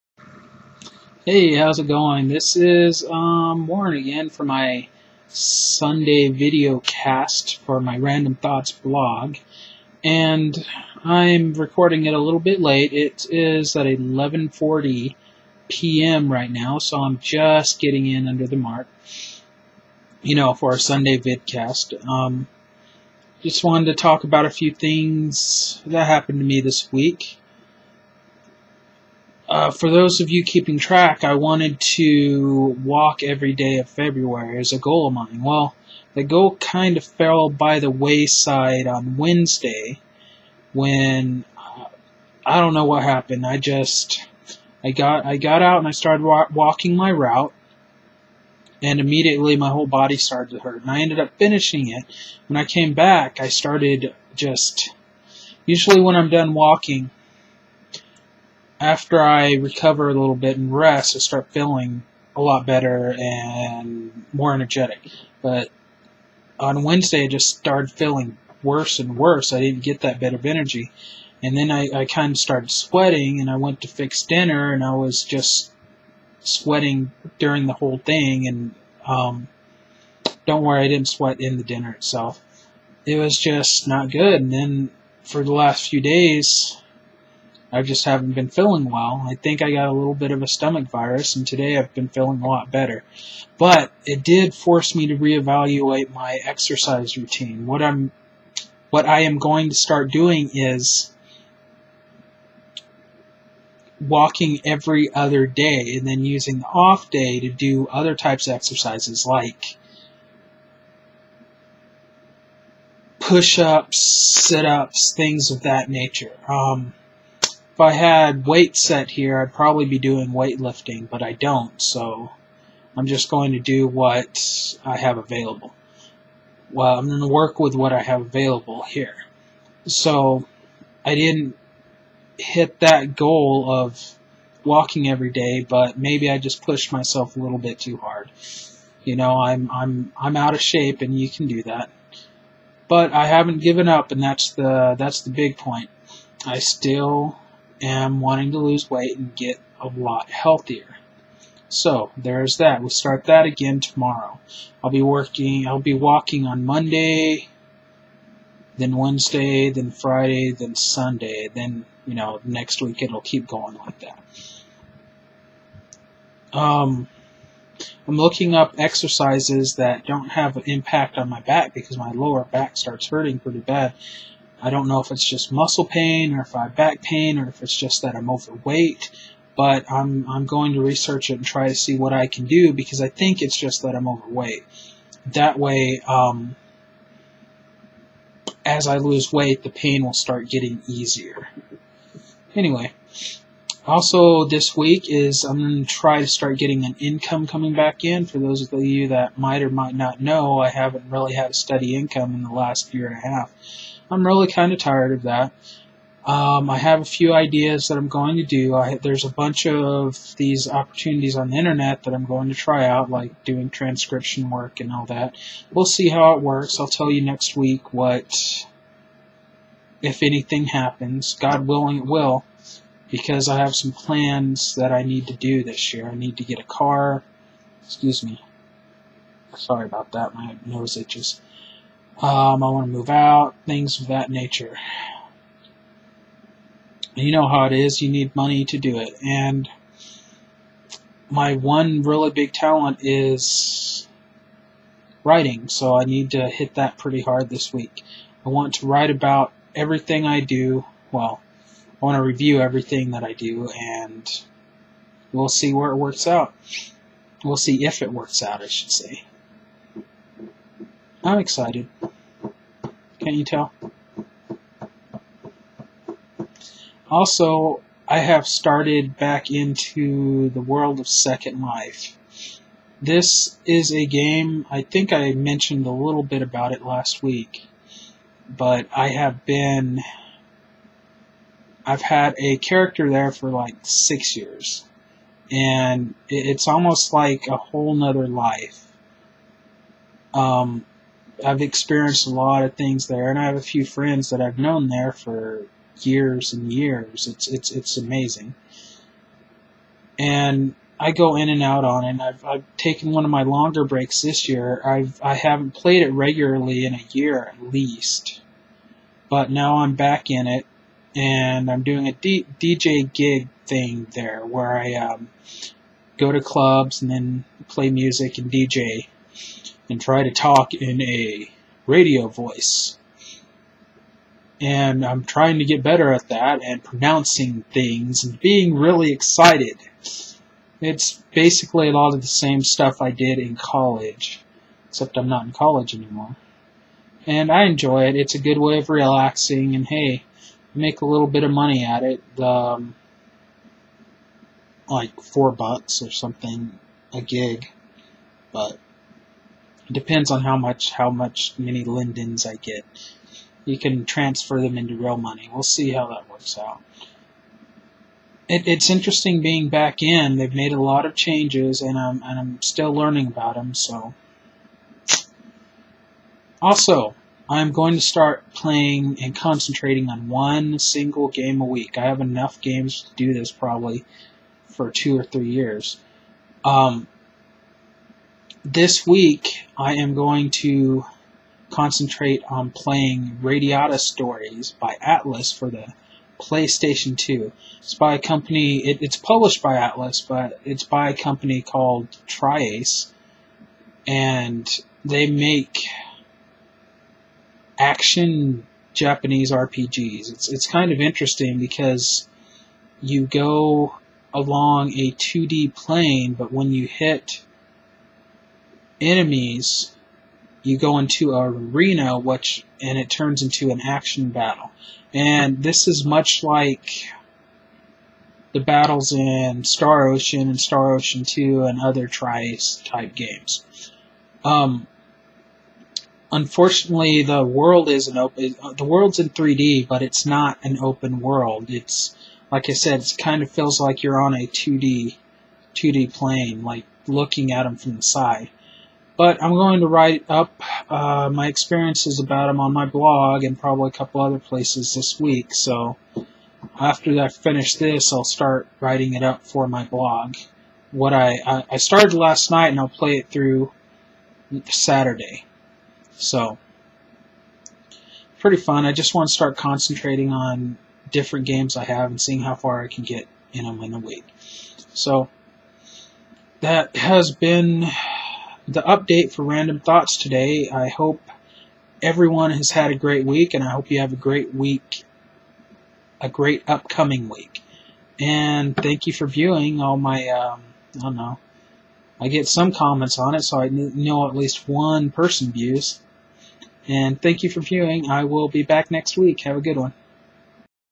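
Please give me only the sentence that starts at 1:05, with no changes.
But on Wednesday, I just started feeling worse and worse.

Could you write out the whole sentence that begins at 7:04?
Um, unfortunately, the world isn't open.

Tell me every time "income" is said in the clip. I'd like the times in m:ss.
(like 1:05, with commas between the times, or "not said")
3:16, 3:21.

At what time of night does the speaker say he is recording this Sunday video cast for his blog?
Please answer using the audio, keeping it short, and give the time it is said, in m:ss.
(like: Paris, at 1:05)
11:40 p.m., at 0:13.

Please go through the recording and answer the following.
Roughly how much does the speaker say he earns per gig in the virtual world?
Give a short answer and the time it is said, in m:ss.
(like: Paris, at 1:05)
4 bucks, at 5:45.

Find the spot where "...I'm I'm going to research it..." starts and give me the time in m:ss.
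2:59.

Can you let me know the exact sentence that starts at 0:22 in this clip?
Um, just wanted to talk about a few things that happened to me this week.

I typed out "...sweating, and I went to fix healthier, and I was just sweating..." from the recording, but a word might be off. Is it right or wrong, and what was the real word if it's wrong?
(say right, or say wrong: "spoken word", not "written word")
wrong: "dinner", not "healthier".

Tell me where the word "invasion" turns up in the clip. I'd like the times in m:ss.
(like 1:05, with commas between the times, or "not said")
not said.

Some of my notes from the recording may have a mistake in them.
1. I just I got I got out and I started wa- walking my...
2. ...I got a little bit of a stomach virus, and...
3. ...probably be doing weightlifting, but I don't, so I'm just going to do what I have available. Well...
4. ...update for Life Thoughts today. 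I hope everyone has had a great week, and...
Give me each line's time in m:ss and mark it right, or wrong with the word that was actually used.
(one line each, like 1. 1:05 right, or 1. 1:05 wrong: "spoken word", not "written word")
1. 0:43 right
2. 1:29 right
3. 1:59 right
4. 7:48 wrong: "Random", not "Life".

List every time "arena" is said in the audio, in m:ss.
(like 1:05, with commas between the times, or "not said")
6:51.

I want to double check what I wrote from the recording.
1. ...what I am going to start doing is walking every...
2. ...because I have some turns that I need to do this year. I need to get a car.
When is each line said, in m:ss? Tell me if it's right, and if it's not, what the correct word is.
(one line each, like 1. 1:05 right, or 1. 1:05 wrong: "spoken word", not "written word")
1. 1:38 right
2. 3:43 wrong: "plans", not "turns".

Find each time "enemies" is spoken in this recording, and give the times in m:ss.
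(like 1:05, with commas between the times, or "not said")
6:49.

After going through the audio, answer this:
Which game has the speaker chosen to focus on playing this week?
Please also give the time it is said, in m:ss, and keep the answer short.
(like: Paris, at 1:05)
Radiata Stories, at 6:23.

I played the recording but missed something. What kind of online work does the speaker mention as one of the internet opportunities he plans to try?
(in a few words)
transcription work.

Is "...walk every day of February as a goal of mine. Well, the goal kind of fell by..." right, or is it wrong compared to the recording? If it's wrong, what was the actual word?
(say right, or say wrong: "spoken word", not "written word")
right.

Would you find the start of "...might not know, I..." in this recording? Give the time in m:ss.
3:19.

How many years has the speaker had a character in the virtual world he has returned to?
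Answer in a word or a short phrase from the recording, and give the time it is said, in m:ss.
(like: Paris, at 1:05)
six years, at 4:43.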